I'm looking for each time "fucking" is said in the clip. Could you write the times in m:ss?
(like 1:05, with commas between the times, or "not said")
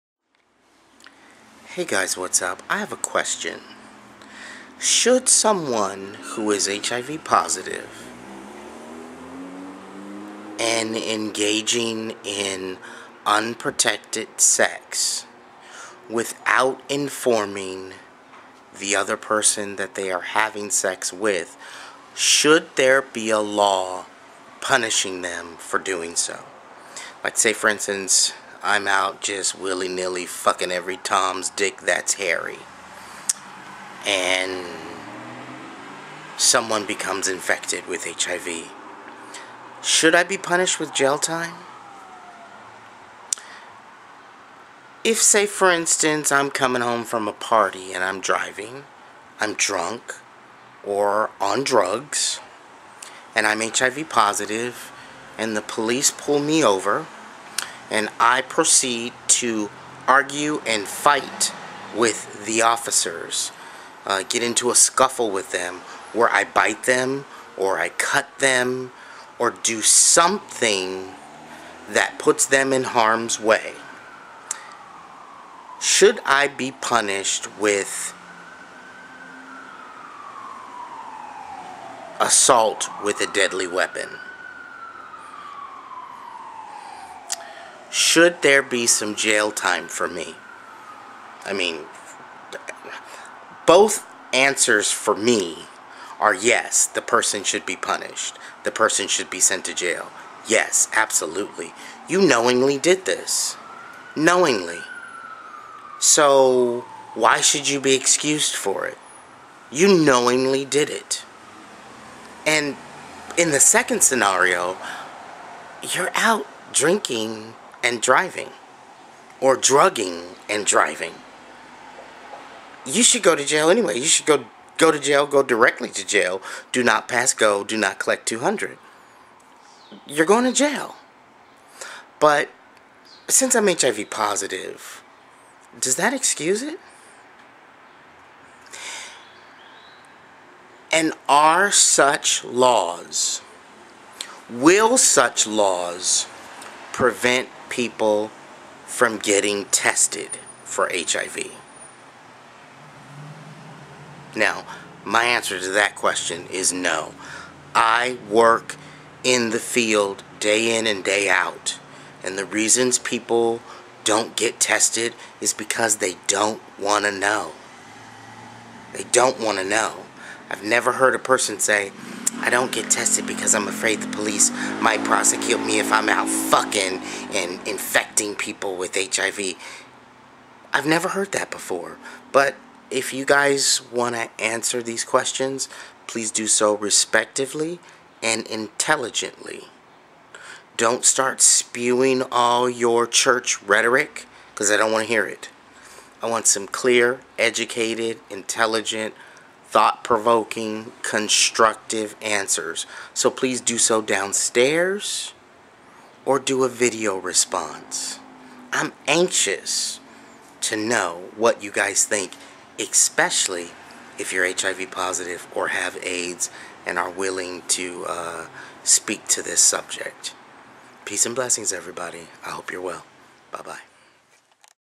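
0:30, 2:56.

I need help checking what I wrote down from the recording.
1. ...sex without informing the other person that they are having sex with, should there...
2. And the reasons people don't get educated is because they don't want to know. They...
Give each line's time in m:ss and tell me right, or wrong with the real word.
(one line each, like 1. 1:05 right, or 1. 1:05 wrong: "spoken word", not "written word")
1. 0:14 right
2. 2:42 wrong: "tested", not "educated".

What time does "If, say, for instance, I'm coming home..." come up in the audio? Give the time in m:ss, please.
0:45.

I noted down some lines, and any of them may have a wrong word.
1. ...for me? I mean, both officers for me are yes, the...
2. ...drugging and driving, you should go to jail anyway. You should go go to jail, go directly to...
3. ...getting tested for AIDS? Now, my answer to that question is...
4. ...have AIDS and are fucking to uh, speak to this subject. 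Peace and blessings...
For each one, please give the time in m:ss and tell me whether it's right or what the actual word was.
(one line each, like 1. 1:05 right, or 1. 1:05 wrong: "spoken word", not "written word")
1. 1:29 wrong: "answers", not "officers"
2. 1:59 right
3. 2:29 wrong: "HIV", not "AIDS"
4. 3:35 wrong: "willing", not "fucking".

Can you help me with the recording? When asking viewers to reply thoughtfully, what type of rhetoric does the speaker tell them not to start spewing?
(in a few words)
church rhetoric.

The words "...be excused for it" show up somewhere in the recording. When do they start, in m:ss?
1:47.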